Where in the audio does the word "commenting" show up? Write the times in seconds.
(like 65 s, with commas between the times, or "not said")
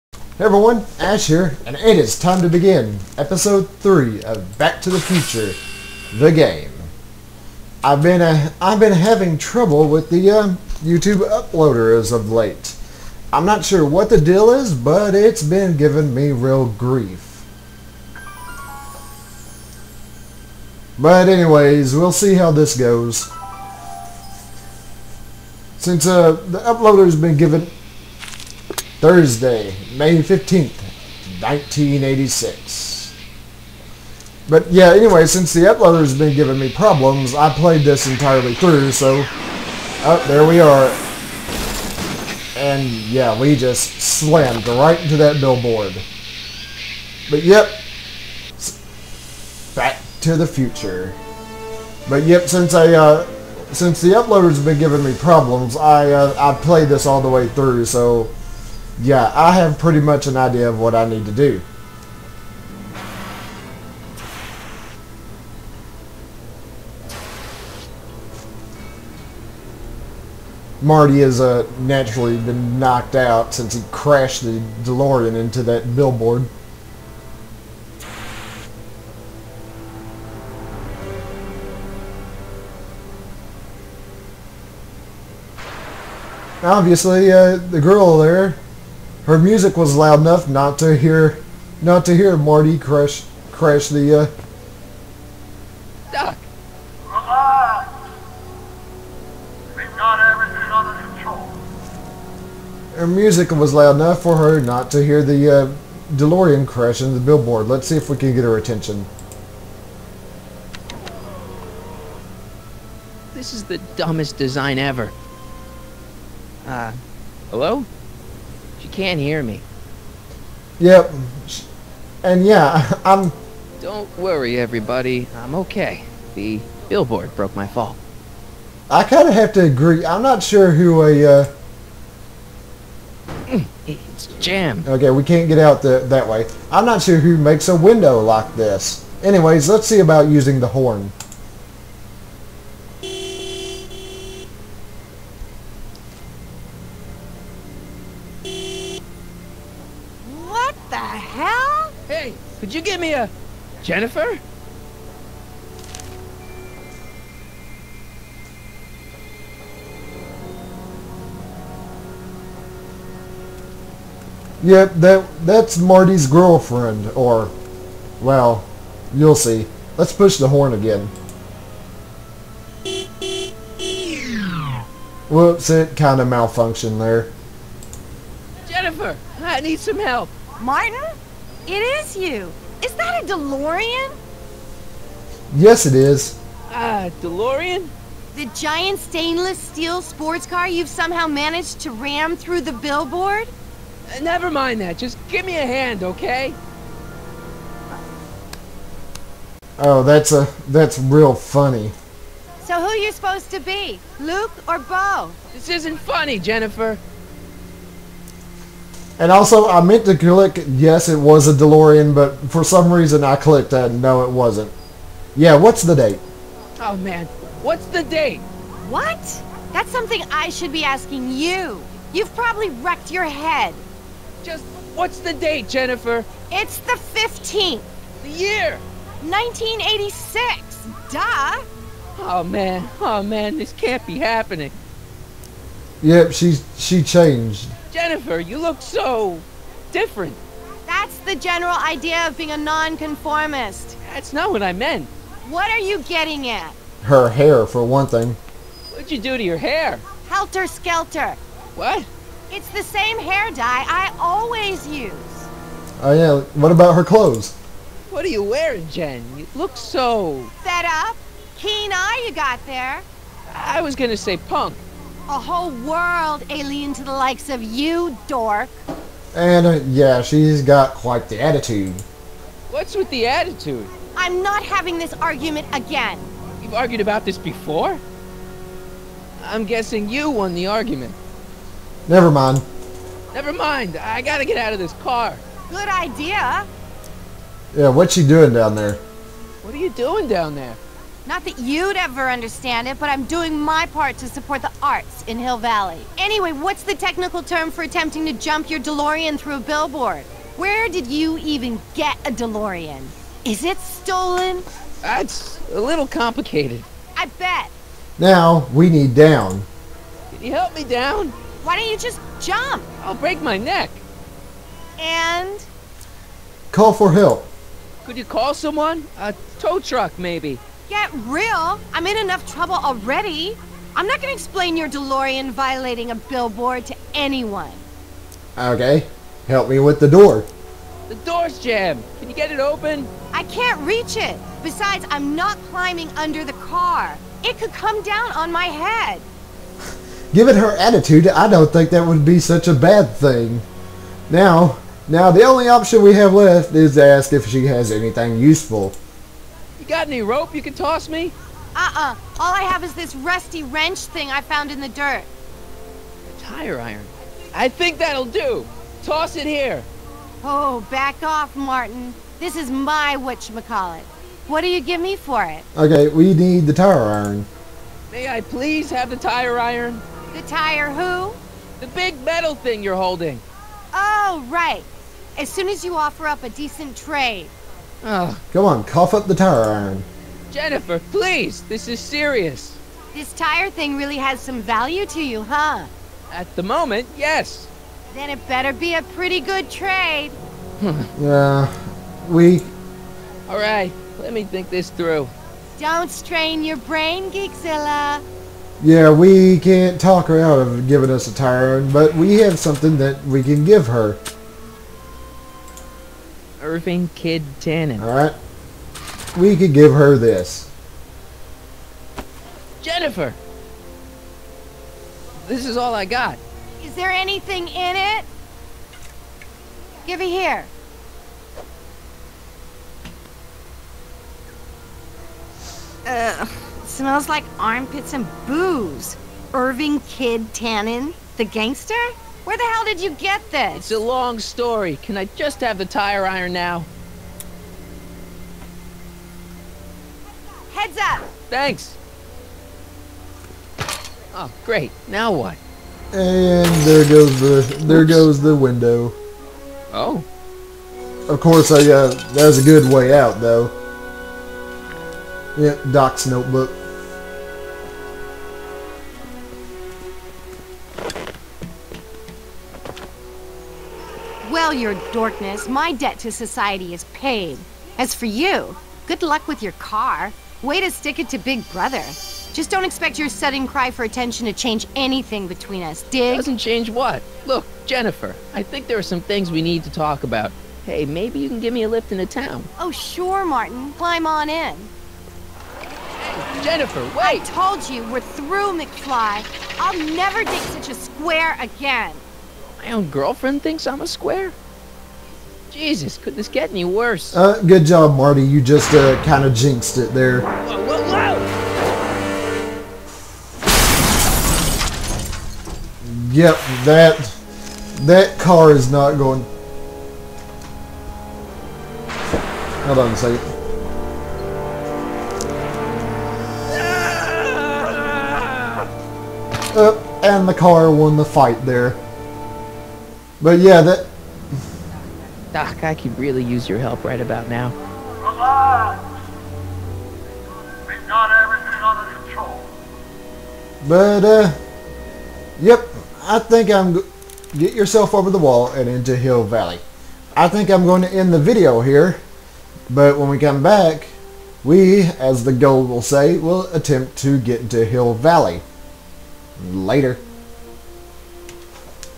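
not said.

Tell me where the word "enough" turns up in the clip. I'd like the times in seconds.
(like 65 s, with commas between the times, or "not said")
90 s, 103 s, 322 s.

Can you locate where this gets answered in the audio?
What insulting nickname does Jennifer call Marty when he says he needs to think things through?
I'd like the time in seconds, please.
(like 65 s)
397 s.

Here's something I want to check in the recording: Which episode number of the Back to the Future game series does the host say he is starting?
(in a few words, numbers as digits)
3.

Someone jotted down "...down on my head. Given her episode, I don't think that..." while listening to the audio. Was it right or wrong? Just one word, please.
wrong.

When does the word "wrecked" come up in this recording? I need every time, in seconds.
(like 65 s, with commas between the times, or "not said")
222 s.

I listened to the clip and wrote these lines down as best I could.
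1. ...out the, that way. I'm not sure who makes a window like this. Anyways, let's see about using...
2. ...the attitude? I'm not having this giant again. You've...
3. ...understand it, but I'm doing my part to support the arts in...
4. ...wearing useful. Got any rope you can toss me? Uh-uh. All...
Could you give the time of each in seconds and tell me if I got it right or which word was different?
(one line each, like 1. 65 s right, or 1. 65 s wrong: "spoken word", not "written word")
1. 135 s right
2. 273 s wrong: "argument", not "giant"
3. 292 s right
4. 347 s wrong: "anything", not "wearing".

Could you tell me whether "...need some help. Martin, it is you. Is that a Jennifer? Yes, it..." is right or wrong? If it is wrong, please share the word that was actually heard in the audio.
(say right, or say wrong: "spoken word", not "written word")
wrong: "DeLorean", not "Jennifer".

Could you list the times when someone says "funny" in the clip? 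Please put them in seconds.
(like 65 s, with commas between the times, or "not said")
201 s, 205 s.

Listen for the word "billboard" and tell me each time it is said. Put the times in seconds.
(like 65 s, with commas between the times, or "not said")
45 s, 75 s, 107 s, 126 s, 192 s, 299 s, 326 s.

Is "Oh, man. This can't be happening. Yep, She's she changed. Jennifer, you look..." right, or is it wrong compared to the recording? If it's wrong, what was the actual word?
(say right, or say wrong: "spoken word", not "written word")
right.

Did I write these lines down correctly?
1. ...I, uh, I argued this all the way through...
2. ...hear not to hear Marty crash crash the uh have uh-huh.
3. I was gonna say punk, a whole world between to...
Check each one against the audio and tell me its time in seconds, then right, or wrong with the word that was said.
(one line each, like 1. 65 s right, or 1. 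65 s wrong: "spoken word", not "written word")
1. 55 s wrong: "played", not "argued"
2. 90 s right
3. 263 s wrong: "alien", not "between".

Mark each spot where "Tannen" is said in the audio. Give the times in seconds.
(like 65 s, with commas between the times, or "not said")
407 s, 430 s.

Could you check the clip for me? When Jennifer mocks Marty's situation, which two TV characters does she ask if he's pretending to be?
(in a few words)
Luke or Bo.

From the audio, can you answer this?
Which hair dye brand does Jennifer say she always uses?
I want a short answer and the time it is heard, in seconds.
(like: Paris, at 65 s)
Helter Skelter, at 250 s.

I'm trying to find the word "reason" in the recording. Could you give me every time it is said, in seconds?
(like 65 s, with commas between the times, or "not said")
212 s.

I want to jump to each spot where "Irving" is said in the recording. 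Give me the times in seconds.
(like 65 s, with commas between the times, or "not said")
406 s, 429 s.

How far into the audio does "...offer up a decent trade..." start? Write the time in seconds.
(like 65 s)
375 s.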